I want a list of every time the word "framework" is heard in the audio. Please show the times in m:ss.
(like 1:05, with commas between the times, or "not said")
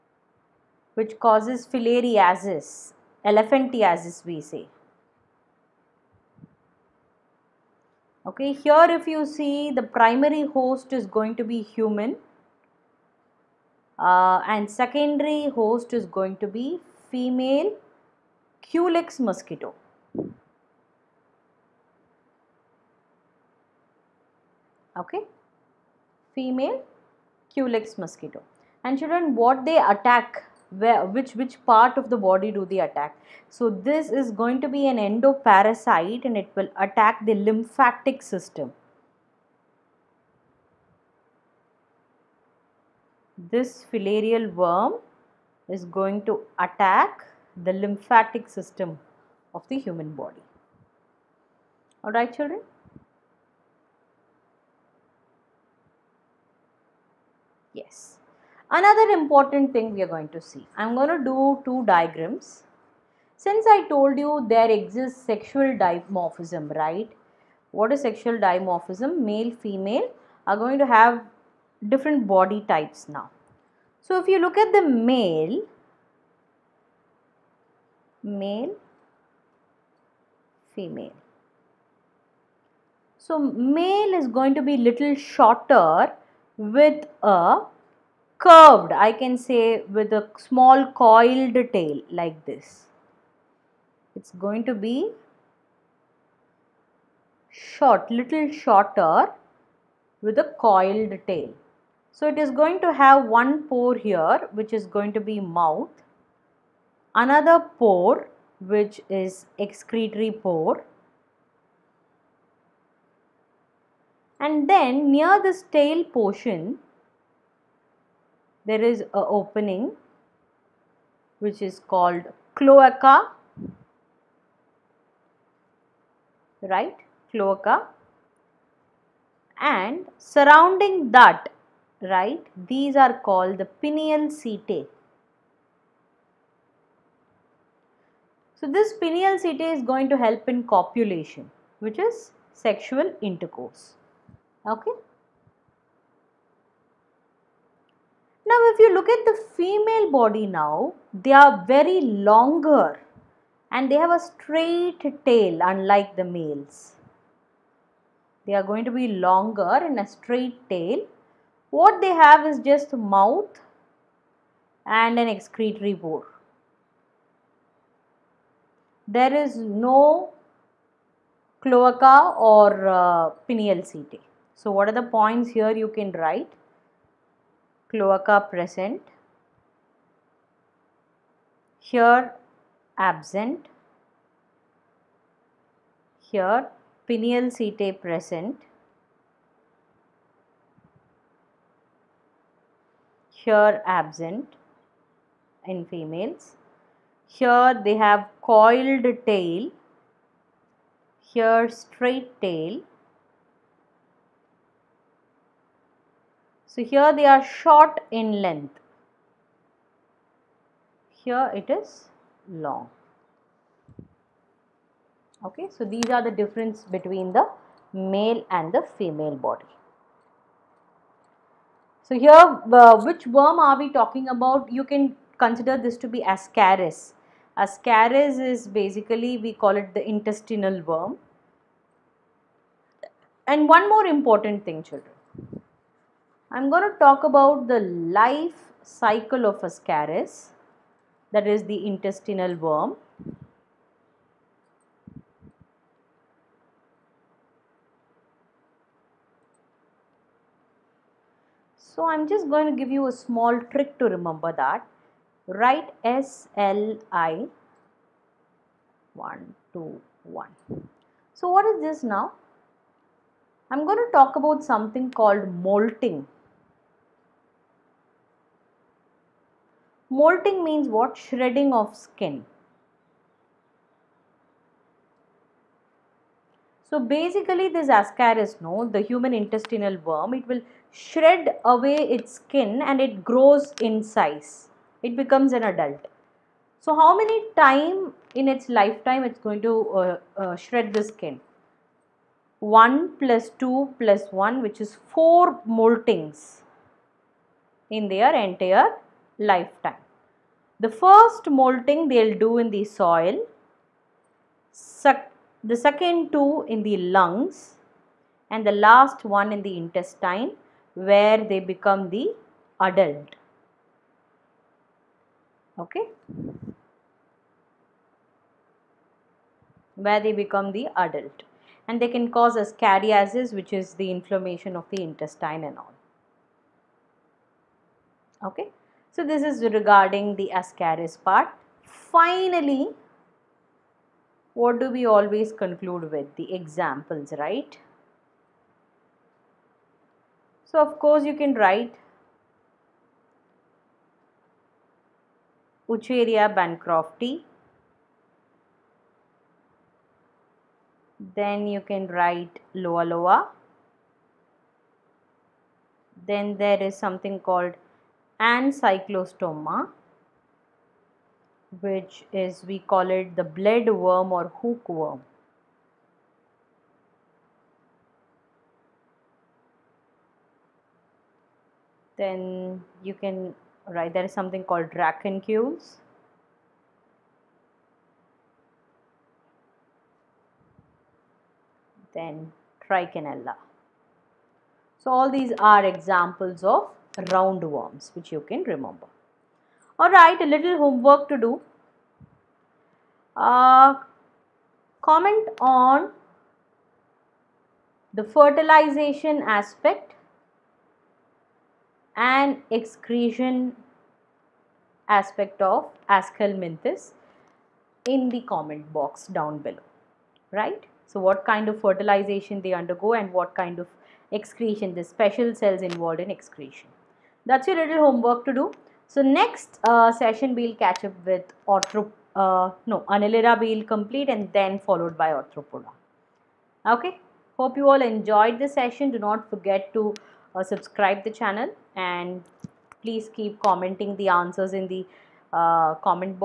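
not said.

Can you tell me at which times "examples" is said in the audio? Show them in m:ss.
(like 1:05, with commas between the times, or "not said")
5:36, 6:25.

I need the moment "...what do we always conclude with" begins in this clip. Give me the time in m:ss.
5:34.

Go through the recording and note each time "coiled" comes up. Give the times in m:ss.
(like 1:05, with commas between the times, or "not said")
1:30, 1:40, 3:18.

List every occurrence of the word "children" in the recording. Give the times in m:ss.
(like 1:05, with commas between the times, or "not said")
0:29, 0:52, 3:54.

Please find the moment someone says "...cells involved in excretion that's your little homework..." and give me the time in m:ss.
6:55.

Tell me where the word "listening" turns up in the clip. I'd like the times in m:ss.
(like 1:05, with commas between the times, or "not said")
not said.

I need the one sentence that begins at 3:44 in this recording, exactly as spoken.
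You can consider this to be ascaris.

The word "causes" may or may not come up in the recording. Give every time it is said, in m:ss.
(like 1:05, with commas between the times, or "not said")
0:01, 5:22.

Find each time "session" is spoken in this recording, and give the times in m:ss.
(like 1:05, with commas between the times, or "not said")
7:00, 7:08.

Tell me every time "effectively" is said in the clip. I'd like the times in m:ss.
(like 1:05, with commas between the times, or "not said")
not said.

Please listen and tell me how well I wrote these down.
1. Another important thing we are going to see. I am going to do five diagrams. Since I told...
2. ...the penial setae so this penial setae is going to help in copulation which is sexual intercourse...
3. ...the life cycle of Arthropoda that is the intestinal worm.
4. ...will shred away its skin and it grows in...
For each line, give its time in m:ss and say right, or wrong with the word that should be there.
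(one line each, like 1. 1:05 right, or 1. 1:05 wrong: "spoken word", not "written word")
1. 0:58 wrong: "two", not "five"
2. 2:13 right
3. 3:57 wrong: "Ascaris", not "Arthropoda"
4. 4:40 right.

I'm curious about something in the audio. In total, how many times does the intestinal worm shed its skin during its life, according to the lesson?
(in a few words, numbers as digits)
4.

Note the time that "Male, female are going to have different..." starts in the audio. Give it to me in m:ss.
1:09.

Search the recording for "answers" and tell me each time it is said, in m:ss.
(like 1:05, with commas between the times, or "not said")
7:14.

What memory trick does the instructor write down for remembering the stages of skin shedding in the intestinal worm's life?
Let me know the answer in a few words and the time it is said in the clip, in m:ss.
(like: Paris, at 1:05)
S L I 1 2 1, at 4:16.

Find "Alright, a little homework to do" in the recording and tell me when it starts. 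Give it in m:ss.
6:29.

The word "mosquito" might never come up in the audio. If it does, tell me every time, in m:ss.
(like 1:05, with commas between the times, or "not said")
0:19, 0:28.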